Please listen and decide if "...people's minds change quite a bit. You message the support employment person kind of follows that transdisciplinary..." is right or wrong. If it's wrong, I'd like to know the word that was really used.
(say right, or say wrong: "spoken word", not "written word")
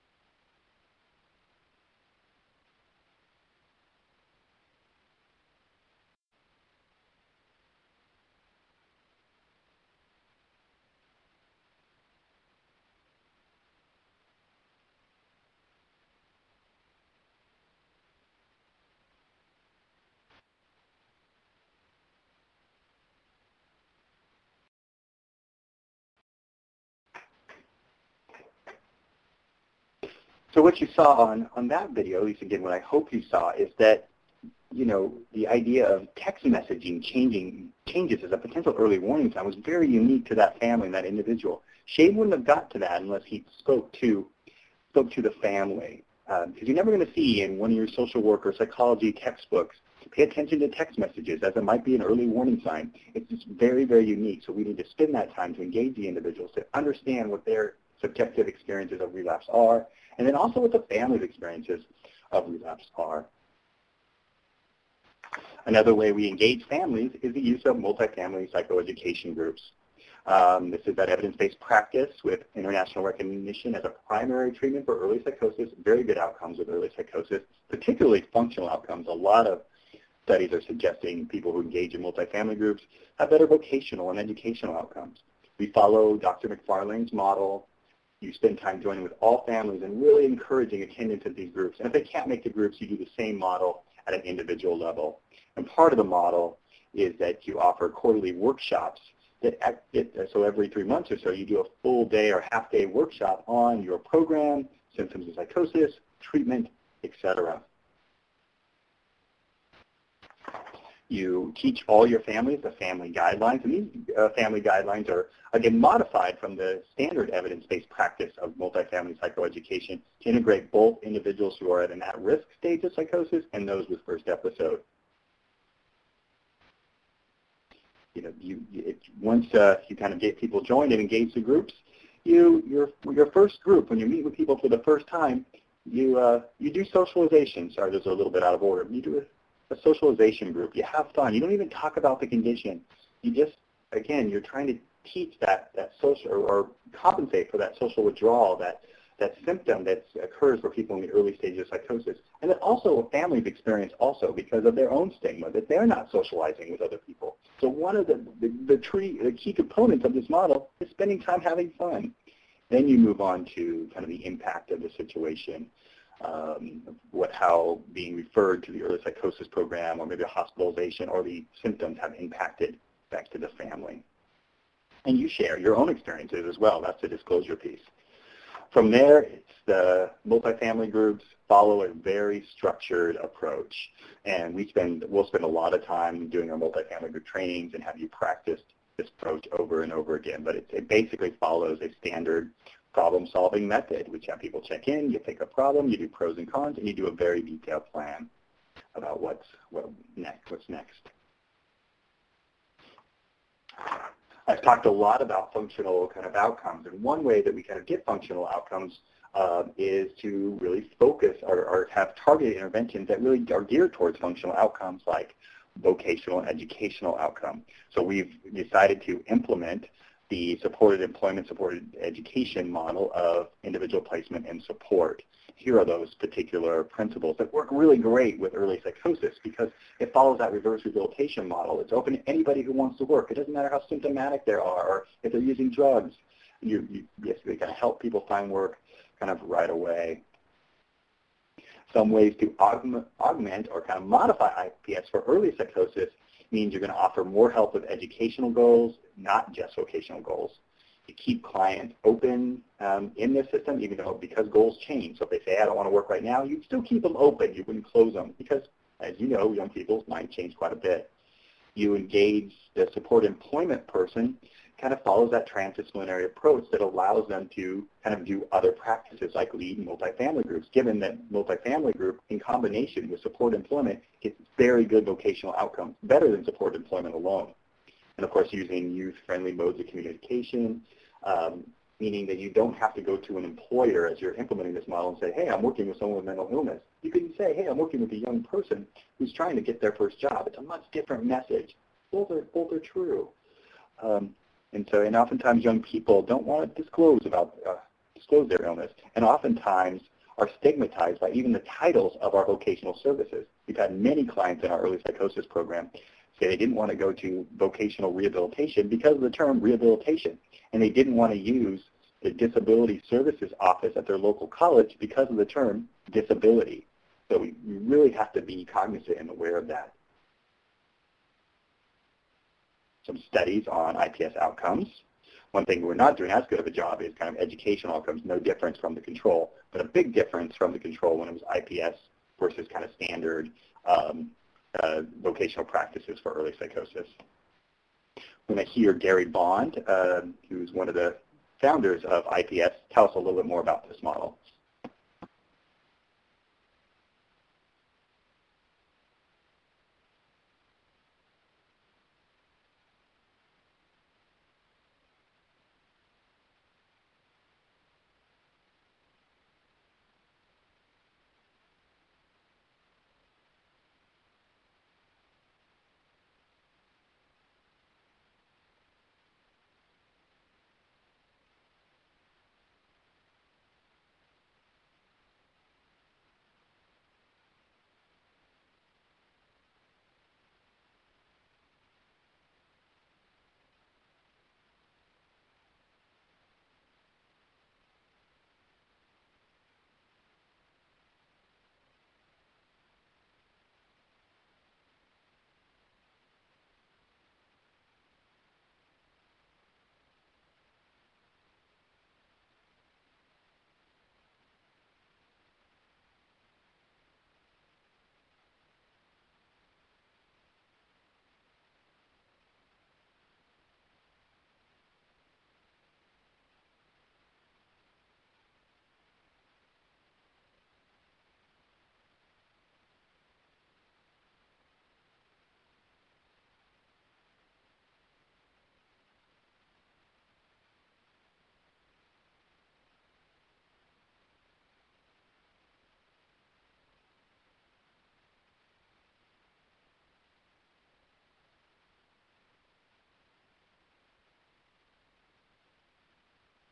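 wrong: "engage", not "message".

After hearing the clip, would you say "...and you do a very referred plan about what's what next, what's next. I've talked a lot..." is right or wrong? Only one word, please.
wrong.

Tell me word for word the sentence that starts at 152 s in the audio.
And that also families experience also because of their own stigma, that they're not socializing with other people.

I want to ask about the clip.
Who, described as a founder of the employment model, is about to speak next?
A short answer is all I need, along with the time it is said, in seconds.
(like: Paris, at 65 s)
Gary Bond, at 338 s.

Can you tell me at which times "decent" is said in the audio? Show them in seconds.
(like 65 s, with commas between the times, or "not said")
not said.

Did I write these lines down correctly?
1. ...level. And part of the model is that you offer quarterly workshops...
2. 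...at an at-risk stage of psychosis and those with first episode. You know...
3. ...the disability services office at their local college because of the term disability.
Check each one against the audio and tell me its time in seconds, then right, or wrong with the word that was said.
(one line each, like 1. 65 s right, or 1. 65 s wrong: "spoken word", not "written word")
1. 94 s right
2. 121 s right
3. 312 s right.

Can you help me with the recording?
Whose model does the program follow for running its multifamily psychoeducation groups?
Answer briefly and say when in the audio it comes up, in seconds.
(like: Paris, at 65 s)
Dr. McFarlane, at 86 s.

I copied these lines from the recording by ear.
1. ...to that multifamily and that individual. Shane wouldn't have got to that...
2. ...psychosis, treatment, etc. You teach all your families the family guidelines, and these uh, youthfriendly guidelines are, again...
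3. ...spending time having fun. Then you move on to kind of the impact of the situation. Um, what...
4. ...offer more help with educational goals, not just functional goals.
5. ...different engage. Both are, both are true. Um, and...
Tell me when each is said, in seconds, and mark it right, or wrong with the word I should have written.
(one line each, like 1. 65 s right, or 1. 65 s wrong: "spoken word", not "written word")
1. 40 s wrong: "family", not "multifamily"
2. 105 s wrong: "family", not "youthfriendly"
3. 160 s right
4. 246 s wrong: "vocational", not "functional"
5. 290 s wrong: "message", not "engage".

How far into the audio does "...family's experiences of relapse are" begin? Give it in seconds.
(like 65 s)
60 s.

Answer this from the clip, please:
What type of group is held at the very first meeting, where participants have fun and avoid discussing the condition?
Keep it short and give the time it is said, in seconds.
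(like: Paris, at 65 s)
Socialization group, at 139 s.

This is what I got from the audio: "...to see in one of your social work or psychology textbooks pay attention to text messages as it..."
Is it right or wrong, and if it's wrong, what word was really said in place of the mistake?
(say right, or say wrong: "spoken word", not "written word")
right.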